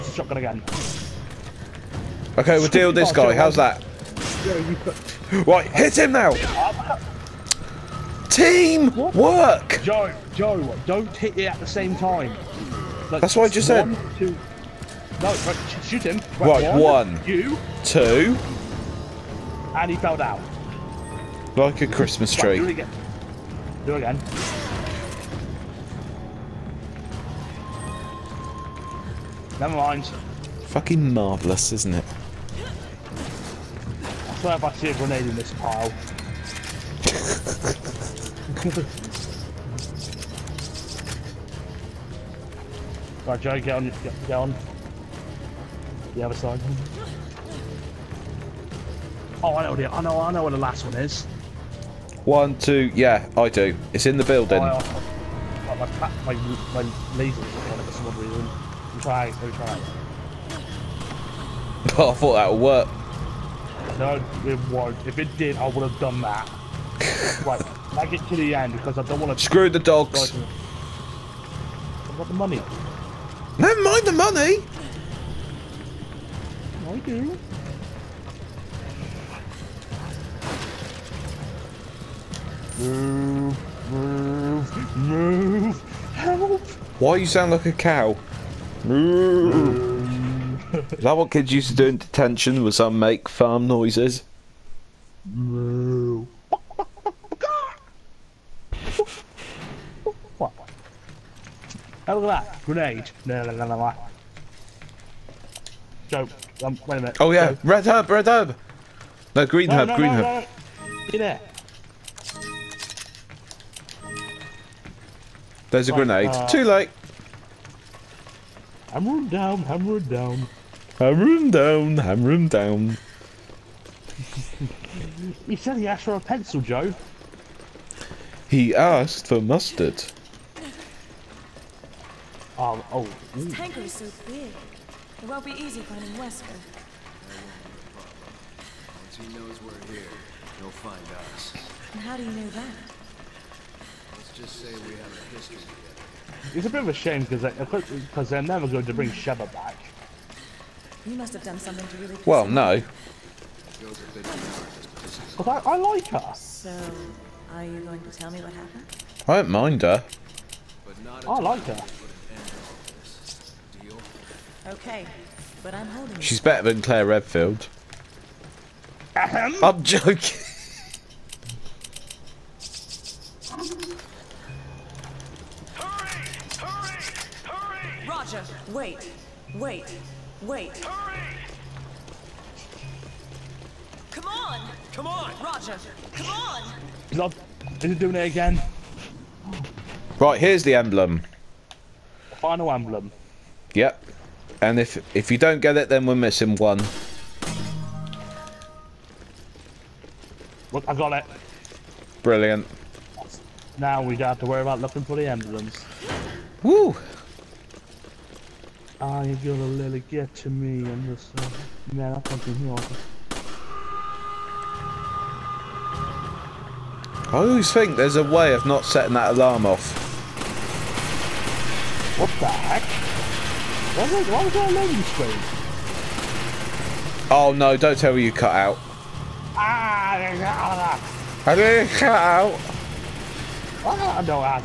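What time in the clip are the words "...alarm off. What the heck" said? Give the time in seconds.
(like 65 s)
219 s.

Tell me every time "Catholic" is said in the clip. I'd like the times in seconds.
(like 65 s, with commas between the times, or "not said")
not said.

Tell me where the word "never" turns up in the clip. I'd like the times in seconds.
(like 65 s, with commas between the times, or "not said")
29 s, 73 s, 148 s.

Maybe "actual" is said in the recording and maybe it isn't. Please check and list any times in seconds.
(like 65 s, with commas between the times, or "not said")
not said.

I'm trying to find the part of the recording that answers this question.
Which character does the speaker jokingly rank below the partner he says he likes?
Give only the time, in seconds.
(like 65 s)
166 s.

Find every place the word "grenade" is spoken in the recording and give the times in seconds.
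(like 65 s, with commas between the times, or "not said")
34 s, 102 s, 115 s.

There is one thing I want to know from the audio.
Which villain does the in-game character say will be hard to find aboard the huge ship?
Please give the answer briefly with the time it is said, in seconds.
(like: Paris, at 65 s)
Wesker, at 136 s.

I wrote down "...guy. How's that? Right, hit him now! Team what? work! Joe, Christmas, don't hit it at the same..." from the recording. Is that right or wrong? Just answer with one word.
wrong.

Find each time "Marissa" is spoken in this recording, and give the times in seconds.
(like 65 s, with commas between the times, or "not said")
not said.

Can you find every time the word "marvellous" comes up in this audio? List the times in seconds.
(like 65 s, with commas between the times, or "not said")
31 s.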